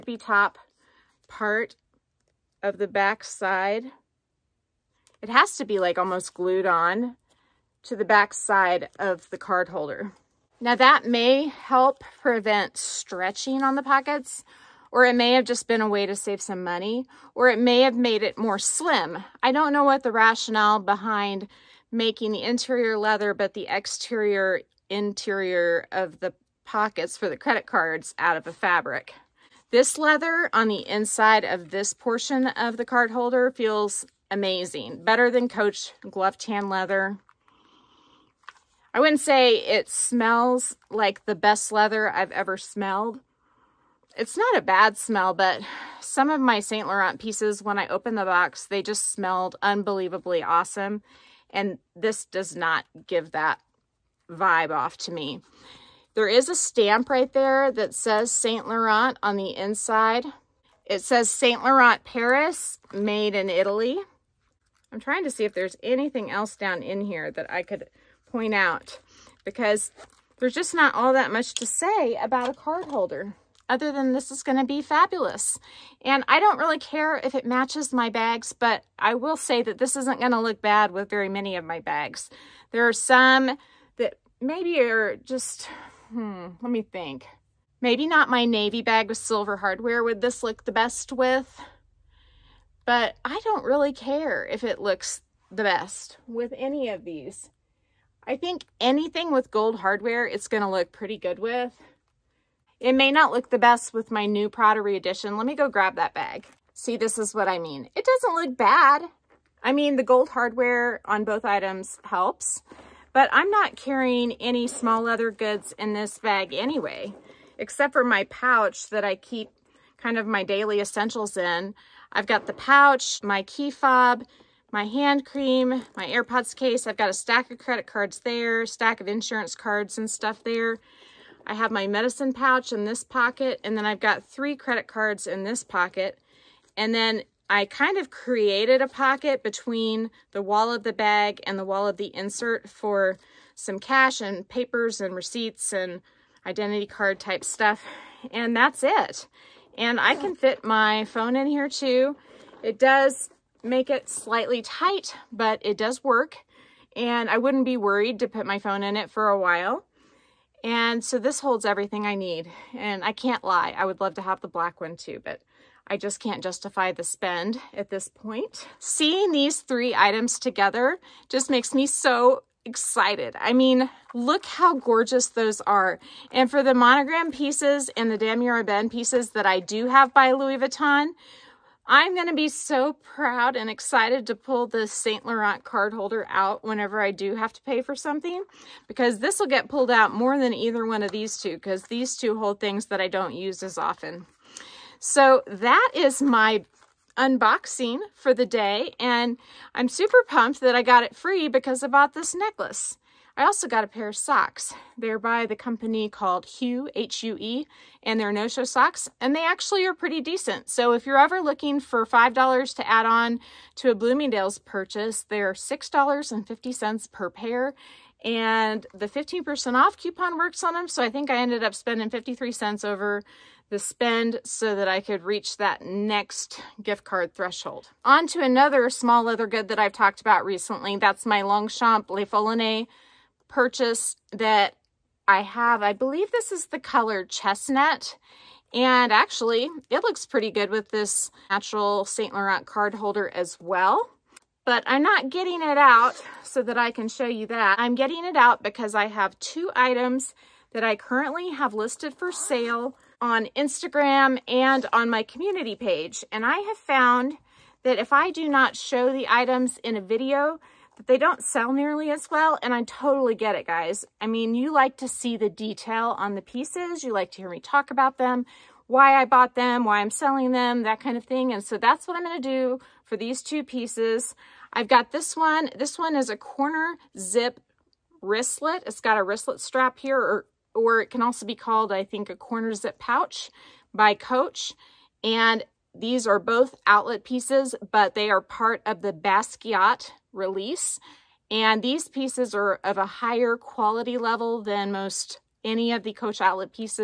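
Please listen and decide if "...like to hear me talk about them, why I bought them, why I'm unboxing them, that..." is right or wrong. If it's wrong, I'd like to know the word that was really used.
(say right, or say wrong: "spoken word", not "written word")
wrong: "selling", not "unboxing".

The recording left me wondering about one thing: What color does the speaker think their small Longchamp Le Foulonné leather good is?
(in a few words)
chestnut.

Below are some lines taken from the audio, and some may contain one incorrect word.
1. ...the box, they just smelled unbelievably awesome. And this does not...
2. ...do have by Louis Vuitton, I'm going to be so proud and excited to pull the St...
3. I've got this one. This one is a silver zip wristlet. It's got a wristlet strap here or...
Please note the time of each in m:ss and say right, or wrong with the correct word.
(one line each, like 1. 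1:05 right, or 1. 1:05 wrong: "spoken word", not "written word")
1. 0:48 right
2. 2:59 right
3. 4:34 wrong: "corner", not "silver".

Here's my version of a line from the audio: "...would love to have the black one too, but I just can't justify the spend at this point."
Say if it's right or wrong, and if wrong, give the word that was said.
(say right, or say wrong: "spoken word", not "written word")
right.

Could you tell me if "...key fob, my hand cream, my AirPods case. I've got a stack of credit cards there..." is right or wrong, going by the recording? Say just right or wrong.
right.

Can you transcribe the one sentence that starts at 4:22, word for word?
And I totally get it, guys.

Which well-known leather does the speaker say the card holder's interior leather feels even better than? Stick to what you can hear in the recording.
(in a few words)
Coach glove tan leather.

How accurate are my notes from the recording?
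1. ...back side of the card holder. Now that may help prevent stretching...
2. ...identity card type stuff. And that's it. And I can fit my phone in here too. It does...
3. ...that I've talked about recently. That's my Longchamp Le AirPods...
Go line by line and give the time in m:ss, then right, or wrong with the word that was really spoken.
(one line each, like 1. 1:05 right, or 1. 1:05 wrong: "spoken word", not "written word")
1. 0:08 right
2. 2:26 right
3. 3:49 wrong: "Foulonné", not "AirPods".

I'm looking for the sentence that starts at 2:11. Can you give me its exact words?
I have my medicine pouch in this pocket, and then I've got three credit cards in this pocket.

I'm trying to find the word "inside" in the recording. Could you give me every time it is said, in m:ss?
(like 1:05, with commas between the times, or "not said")
0:30, 0:59.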